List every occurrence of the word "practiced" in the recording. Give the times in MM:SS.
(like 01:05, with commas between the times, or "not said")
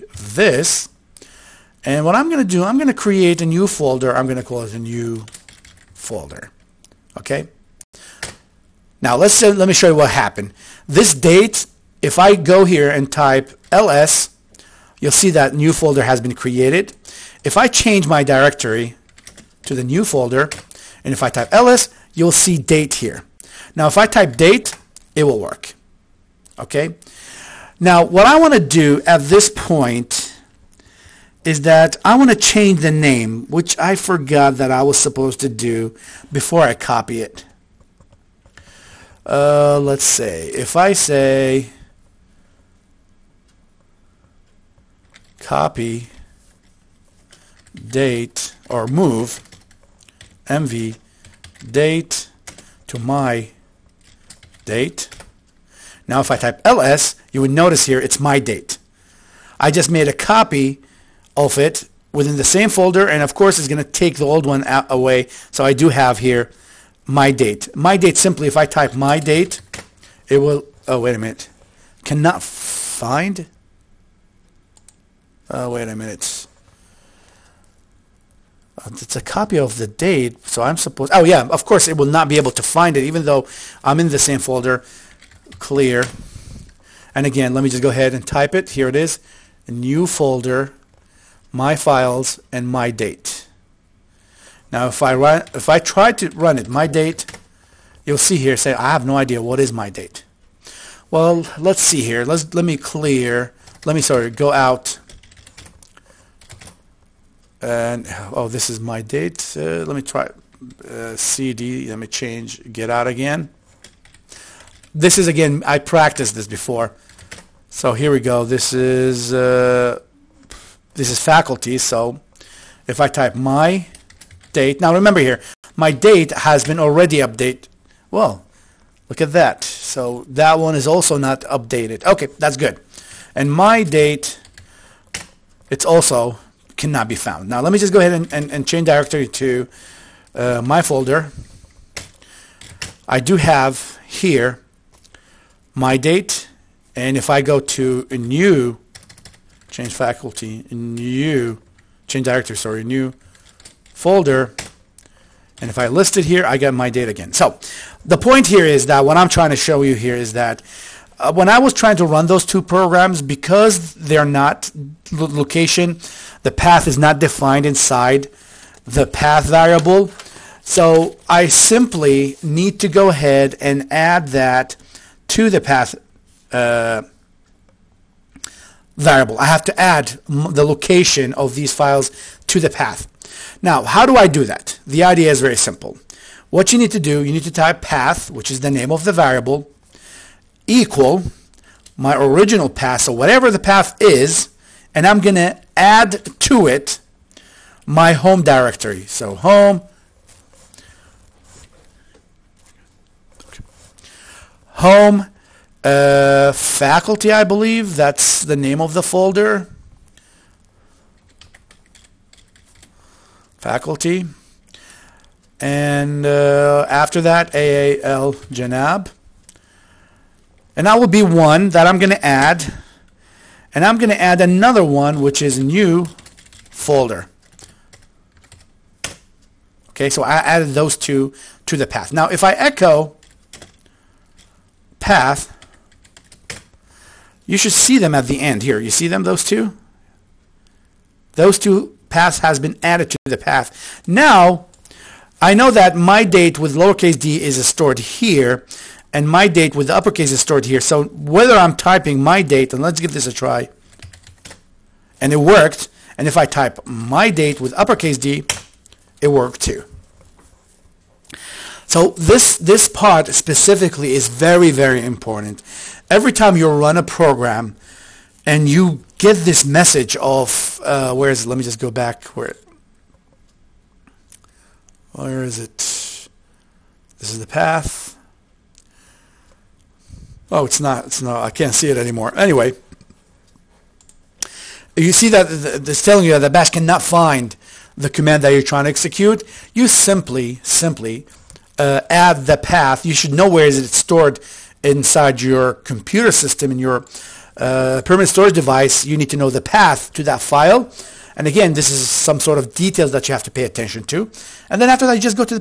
01:55.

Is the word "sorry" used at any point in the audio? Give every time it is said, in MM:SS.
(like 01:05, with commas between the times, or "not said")
01:44, 02:32.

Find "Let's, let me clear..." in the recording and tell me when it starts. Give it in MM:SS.
01:42.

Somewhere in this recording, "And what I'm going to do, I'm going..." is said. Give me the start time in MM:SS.
00:01.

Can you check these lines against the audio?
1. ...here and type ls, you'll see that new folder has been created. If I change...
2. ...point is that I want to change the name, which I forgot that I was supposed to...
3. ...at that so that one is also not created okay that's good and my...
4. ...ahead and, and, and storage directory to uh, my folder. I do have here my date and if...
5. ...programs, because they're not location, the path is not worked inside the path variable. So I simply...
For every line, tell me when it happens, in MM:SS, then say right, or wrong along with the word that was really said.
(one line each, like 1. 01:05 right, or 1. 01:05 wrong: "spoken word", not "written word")
1. 00:12 right
2. 00:29 right
3. 02:09 wrong: "updated", not "created"
4. 02:17 wrong: "change", not "storage"
5. 02:42 wrong: "defined", not "worked".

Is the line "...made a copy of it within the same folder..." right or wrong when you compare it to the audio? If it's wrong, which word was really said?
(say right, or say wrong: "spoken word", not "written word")
right.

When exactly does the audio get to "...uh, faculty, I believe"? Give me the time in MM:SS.
03:25.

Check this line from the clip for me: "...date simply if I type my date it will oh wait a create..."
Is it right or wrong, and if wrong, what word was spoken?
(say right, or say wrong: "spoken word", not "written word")
wrong: "minute", not "create".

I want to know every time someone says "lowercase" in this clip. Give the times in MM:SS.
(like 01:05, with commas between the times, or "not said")
04:06.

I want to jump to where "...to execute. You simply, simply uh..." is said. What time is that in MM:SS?
04:48.